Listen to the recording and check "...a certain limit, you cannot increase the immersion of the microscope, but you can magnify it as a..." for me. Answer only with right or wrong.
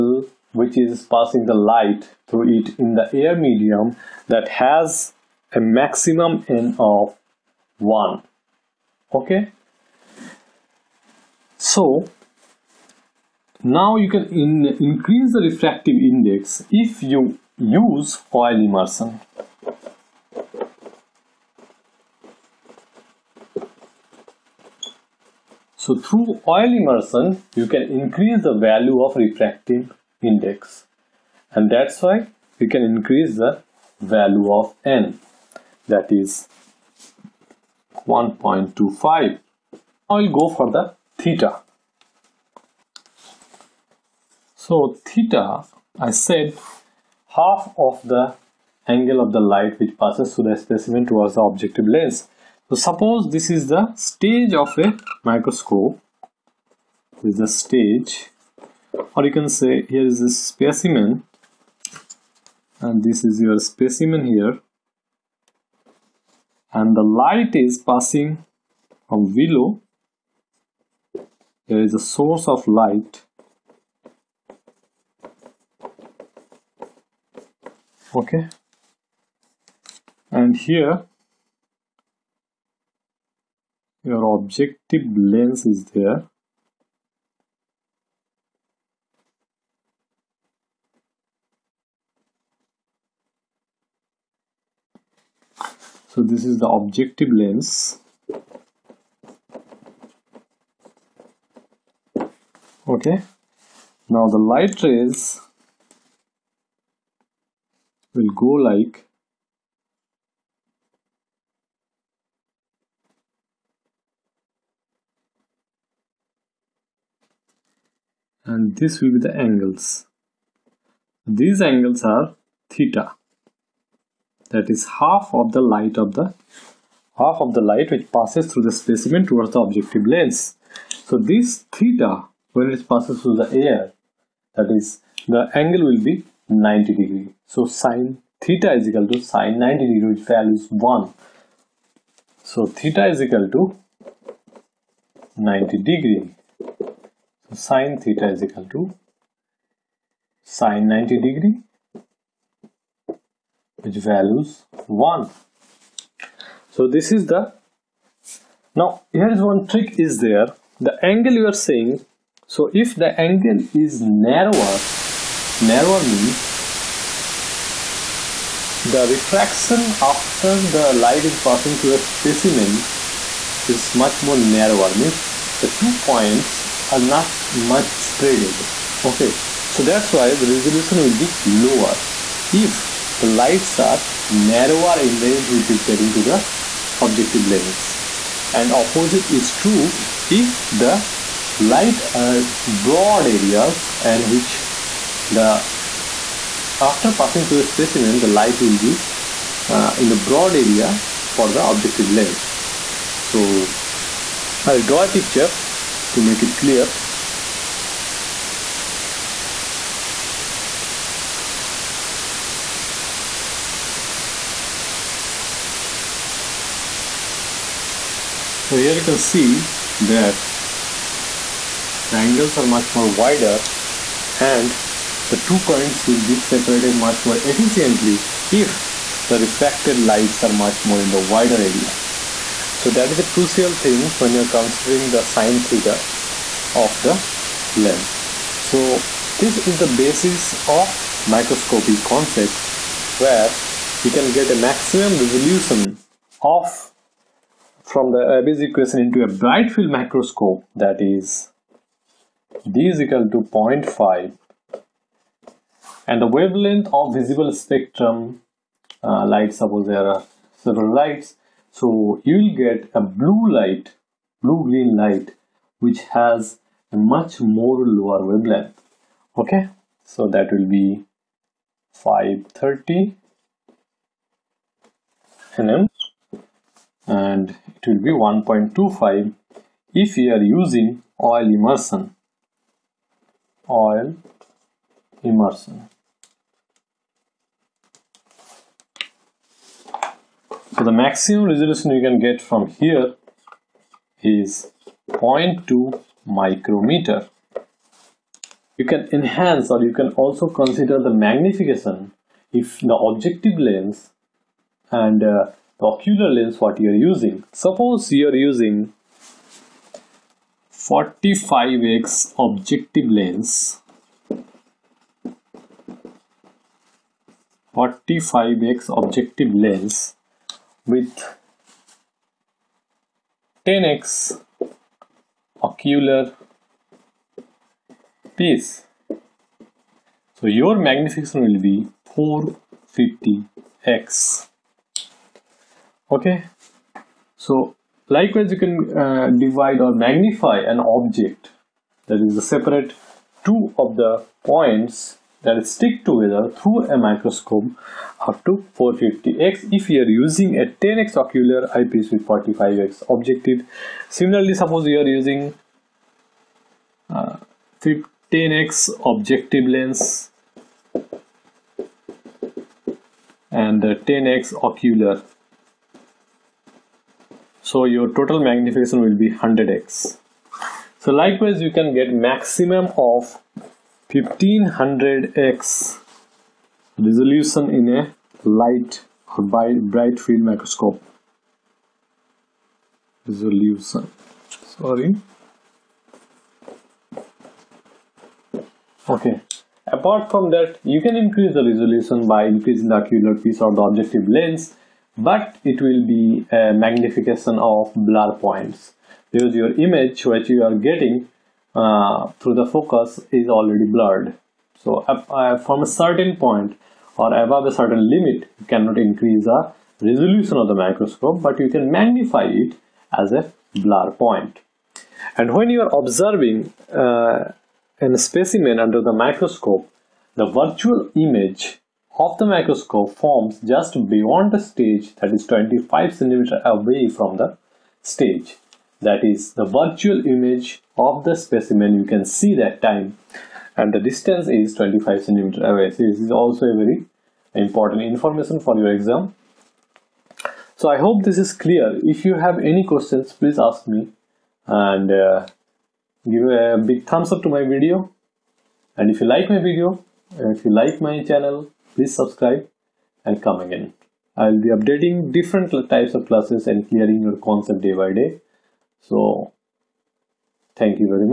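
wrong.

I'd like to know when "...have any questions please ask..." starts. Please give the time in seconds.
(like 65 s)
442 s.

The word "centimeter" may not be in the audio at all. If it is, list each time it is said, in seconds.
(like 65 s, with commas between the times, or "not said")
426 s, 435 s.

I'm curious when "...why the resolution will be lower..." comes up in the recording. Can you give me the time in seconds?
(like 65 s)
180 s.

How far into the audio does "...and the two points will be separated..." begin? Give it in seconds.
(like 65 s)
224 s.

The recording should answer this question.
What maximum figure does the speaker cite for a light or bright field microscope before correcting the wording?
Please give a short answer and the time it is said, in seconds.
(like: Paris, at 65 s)
1500x, at 374 s.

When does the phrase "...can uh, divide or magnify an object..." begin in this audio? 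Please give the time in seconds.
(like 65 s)
338 s.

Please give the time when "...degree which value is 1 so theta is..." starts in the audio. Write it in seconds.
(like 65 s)
139 s.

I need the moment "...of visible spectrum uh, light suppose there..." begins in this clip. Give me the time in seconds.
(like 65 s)
256 s.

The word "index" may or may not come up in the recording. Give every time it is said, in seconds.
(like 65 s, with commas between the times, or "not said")
16 s, 30 s.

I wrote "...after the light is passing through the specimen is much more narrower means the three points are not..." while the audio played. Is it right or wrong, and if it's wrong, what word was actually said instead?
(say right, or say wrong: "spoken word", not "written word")
wrong: "two", not "three".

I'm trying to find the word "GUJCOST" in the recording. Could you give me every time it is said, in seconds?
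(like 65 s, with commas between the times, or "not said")
not said.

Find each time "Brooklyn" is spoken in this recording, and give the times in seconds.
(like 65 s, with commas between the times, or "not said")
not said.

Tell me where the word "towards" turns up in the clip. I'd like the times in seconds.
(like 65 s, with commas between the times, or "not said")
51 s, 129 s.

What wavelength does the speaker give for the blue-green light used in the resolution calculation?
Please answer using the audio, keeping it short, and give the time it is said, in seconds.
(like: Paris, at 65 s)
530 nm, at 271 s.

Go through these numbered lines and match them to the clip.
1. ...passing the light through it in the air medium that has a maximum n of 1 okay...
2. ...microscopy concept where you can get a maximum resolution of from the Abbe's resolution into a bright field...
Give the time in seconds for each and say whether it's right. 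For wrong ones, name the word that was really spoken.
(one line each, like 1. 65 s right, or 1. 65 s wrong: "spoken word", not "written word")
1. 1 s right
2. 241 s wrong: "equation", not "resolution".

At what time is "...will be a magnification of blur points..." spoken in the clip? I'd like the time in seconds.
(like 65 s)
395 s.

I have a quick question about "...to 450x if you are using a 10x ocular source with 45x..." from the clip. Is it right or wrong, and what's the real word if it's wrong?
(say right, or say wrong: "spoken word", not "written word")
wrong: "eyepiece", not "source".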